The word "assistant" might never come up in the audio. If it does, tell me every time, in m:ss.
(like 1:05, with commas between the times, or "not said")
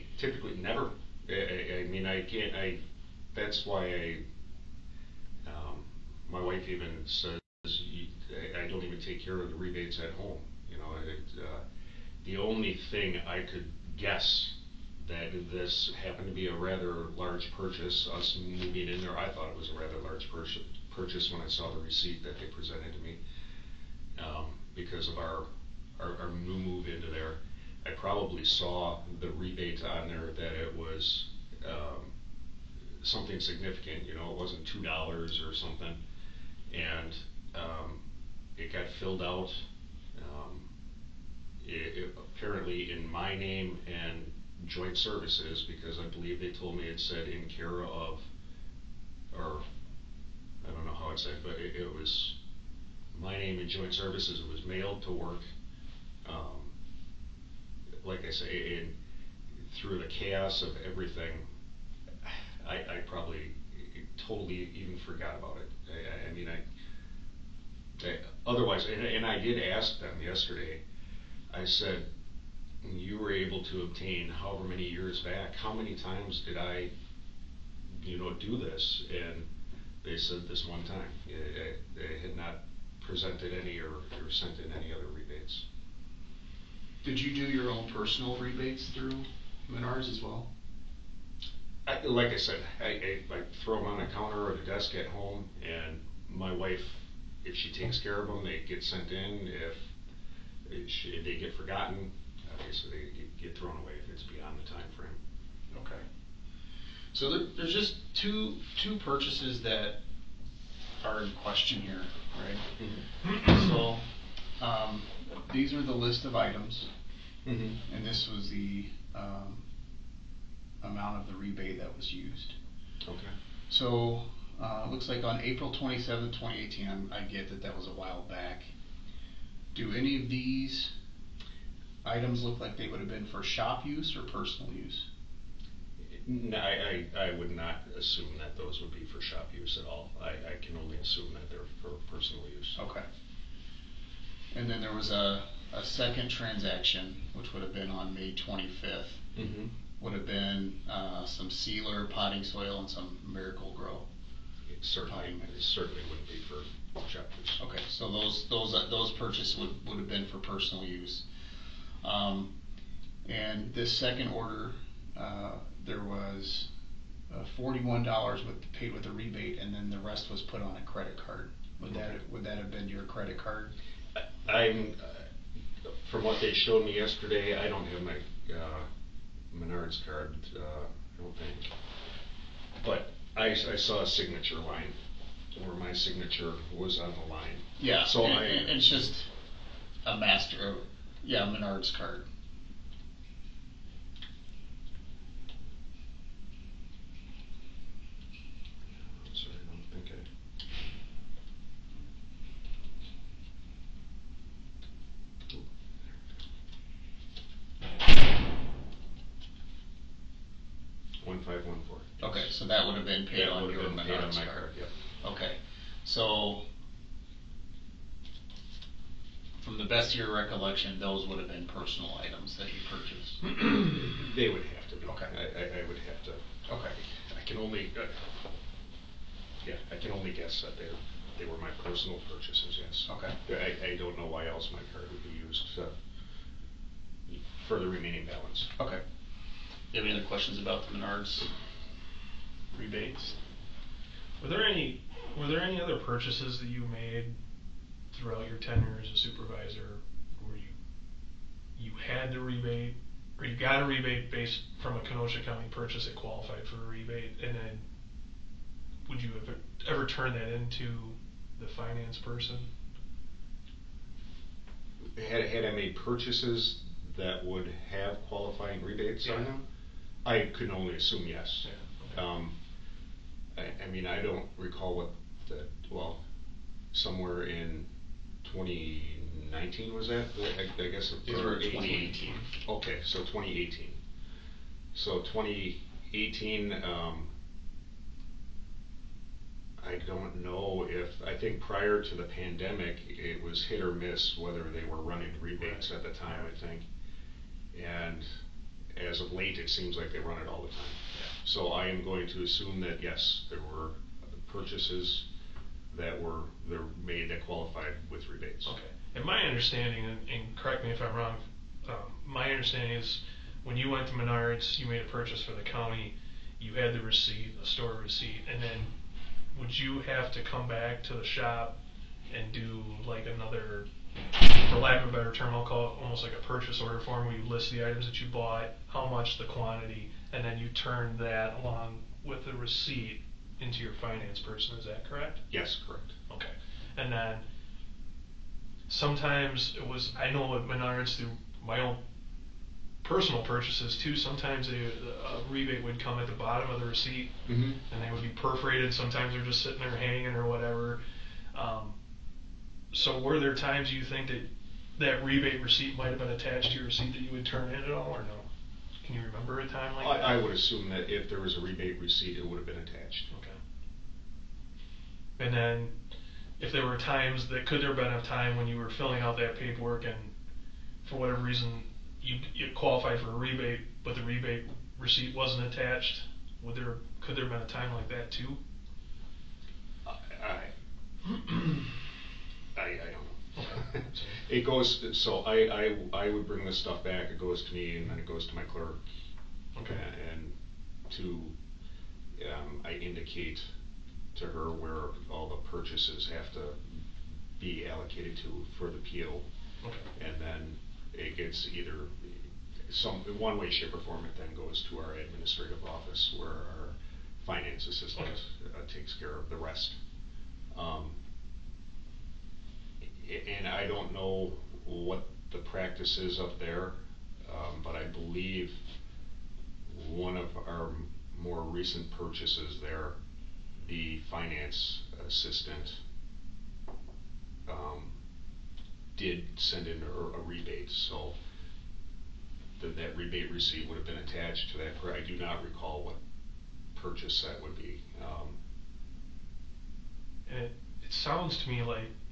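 6:47, 7:05.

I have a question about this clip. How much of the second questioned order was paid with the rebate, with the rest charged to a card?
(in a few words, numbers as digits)
$41.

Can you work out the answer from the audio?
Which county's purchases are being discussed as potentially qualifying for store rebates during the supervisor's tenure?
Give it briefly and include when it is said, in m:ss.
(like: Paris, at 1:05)
Kenosha County, at 4:15.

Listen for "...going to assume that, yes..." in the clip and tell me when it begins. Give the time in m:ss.
5:02.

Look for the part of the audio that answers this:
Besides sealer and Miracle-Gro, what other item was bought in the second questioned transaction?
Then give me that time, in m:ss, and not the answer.
2:32.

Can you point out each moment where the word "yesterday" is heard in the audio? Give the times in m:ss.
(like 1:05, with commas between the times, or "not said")
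1:10, 2:56.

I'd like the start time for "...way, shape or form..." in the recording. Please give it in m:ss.
6:43.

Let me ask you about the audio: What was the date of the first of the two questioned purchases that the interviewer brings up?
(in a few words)
April 27, 2018.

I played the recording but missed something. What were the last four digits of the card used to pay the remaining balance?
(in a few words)
1514.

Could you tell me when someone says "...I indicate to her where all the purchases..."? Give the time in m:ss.
6:32.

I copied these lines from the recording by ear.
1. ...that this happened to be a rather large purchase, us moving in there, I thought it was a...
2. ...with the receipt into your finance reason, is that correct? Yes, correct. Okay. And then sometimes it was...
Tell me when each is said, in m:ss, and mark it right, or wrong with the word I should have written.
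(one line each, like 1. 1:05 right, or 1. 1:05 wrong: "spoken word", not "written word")
1. 0:15 right
2. 5:32 wrong: "person", not "reason".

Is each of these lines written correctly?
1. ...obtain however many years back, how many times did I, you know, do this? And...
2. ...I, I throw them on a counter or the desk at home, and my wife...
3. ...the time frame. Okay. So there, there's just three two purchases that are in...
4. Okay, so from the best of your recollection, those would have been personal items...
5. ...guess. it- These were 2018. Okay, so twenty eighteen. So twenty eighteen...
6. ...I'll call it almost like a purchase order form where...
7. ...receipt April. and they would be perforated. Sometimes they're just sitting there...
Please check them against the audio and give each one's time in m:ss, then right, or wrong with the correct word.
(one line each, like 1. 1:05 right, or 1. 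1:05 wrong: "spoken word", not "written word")
1. 1:13 right
2. 1:32 right
3. 1:44 wrong: "two", not "three"
4. 3:35 right
5. 4:40 right
6. 5:25 right
7. 5:46 wrong: "Mhm", not "April".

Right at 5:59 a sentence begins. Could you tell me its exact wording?
Can you remember a time like that?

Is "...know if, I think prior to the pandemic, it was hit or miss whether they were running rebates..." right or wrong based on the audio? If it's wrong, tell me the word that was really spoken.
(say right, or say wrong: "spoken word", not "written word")
right.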